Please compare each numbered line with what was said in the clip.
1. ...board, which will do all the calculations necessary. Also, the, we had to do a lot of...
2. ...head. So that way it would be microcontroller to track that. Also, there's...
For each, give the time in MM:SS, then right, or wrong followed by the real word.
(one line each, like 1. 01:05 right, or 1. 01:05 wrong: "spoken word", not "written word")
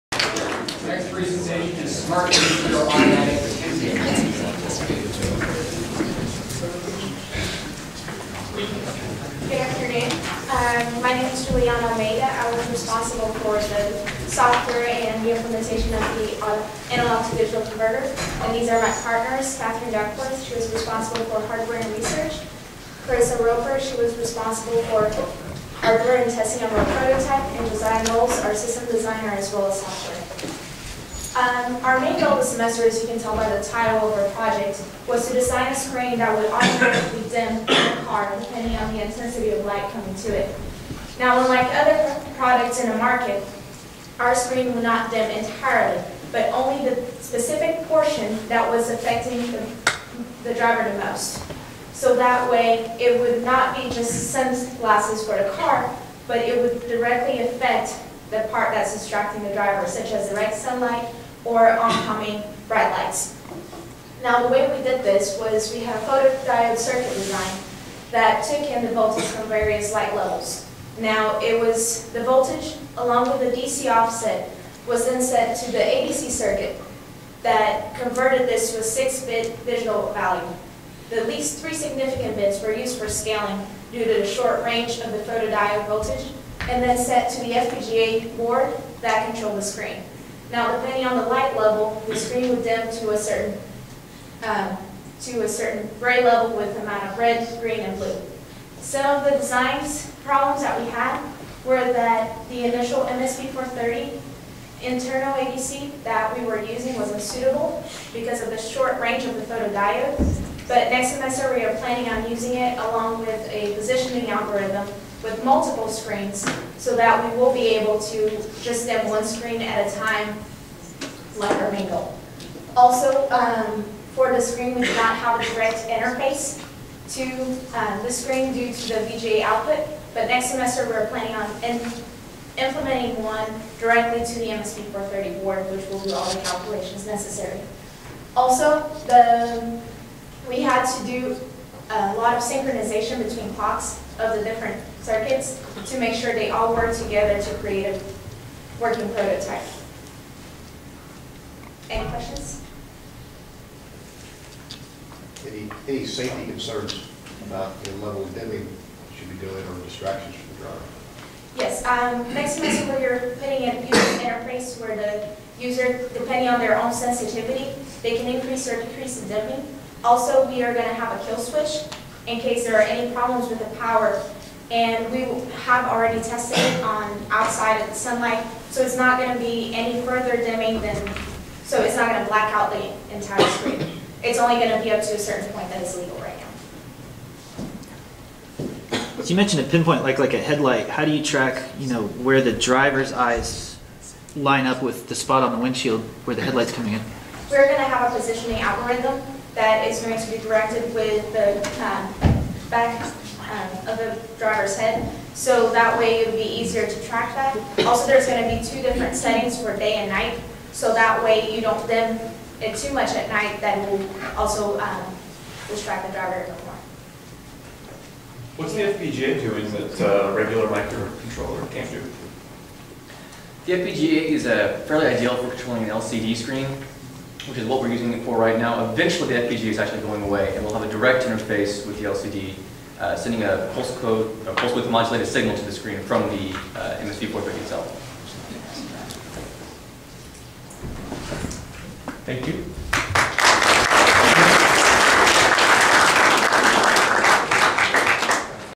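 1. 02:15 right
2. 03:24 wrong: "easier", not "microcontroller".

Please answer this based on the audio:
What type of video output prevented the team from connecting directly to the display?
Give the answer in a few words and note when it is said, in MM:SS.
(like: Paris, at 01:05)
VGA, at 02:09.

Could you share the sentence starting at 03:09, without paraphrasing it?
So you mentioned a pinpoint, like like a headlight.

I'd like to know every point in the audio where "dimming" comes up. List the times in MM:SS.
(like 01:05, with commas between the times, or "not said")
02:38, 02:49, 03:00.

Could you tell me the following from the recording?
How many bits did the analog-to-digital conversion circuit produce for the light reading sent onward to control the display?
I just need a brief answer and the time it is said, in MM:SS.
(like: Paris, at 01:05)
6, at 01:18.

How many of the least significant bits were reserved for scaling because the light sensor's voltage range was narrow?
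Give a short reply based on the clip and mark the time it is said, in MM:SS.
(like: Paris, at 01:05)
3, at 01:21.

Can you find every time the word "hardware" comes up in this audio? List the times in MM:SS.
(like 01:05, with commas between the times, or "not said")
00:21, 00:25.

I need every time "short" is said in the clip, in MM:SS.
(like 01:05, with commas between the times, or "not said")
01:24, 01:48.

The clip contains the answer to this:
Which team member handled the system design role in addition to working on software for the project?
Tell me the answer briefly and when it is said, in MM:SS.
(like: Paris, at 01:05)
Josiah Knowles, at 00:27.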